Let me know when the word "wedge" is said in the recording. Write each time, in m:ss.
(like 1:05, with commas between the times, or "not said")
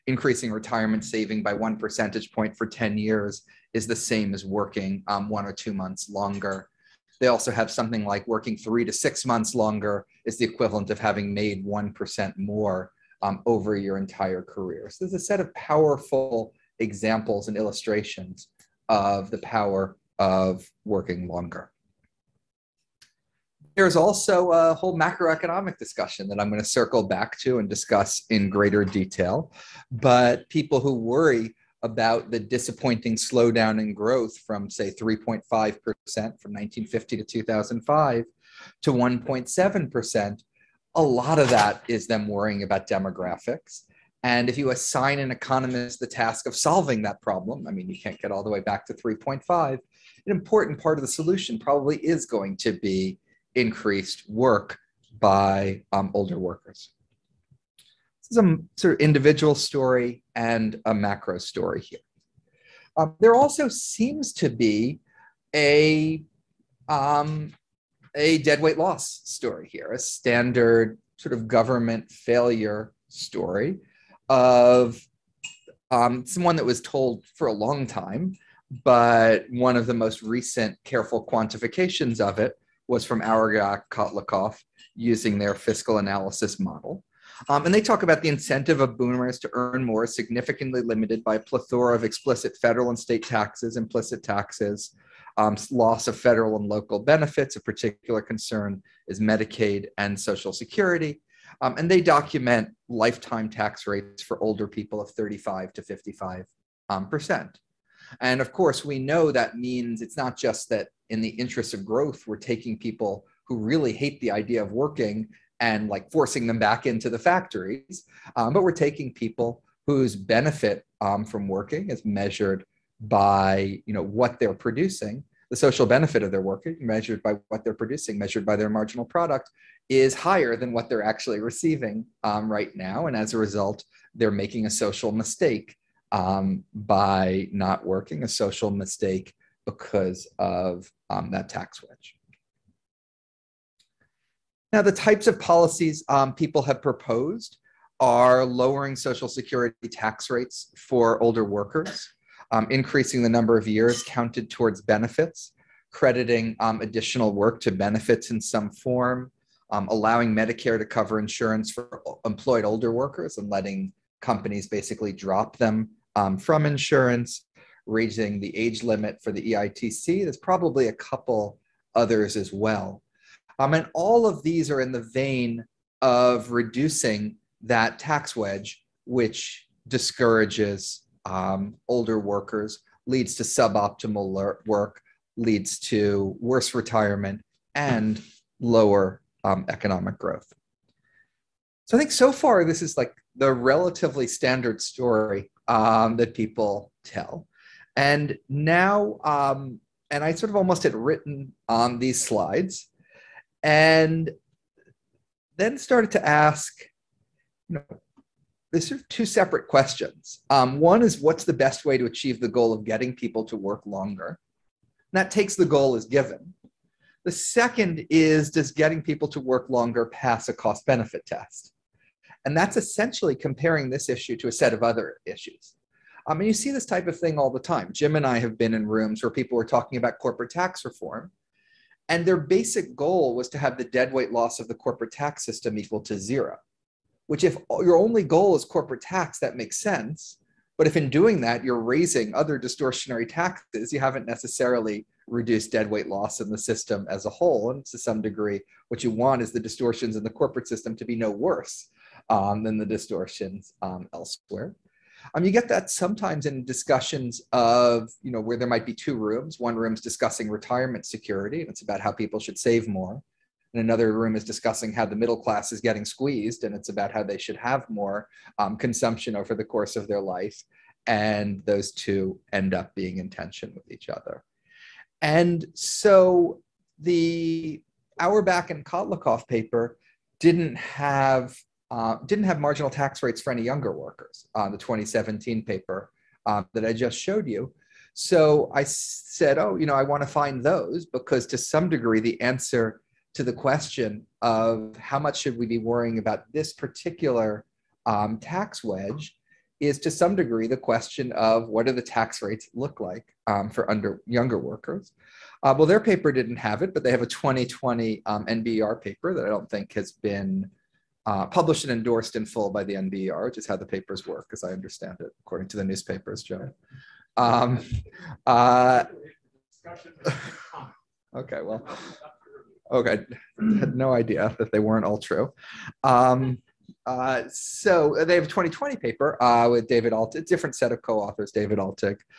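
2:21, 2:58, 4:58.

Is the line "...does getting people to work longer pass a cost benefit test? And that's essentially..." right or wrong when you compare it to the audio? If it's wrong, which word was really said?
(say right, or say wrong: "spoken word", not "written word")
right.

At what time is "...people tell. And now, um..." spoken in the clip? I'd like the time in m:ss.
3:16.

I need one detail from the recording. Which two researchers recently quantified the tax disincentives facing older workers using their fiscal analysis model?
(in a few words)
Auerbach and Kotlikoff.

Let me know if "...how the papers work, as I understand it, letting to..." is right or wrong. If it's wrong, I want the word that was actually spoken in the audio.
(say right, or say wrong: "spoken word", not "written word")
wrong: "according", not "letting".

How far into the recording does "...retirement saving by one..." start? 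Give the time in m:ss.
0:00.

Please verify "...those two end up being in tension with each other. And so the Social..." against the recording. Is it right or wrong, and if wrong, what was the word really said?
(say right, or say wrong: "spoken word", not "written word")
wrong: "Auerbach", not "Social".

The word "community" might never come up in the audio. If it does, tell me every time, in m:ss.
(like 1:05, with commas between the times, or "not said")
not said.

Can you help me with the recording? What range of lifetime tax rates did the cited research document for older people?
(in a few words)
35 to 55 percent.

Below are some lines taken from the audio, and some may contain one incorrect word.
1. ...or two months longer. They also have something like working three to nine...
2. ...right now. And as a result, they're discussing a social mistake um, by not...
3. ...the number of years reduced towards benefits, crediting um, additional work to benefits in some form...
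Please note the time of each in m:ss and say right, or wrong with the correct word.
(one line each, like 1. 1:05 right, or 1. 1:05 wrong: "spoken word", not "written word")
1. 0:05 wrong: "six", not "nine"
2. 2:12 wrong: "making", not "discussing"
3. 2:33 wrong: "counted", not "reduced".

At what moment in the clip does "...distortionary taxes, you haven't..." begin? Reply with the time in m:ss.
4:02.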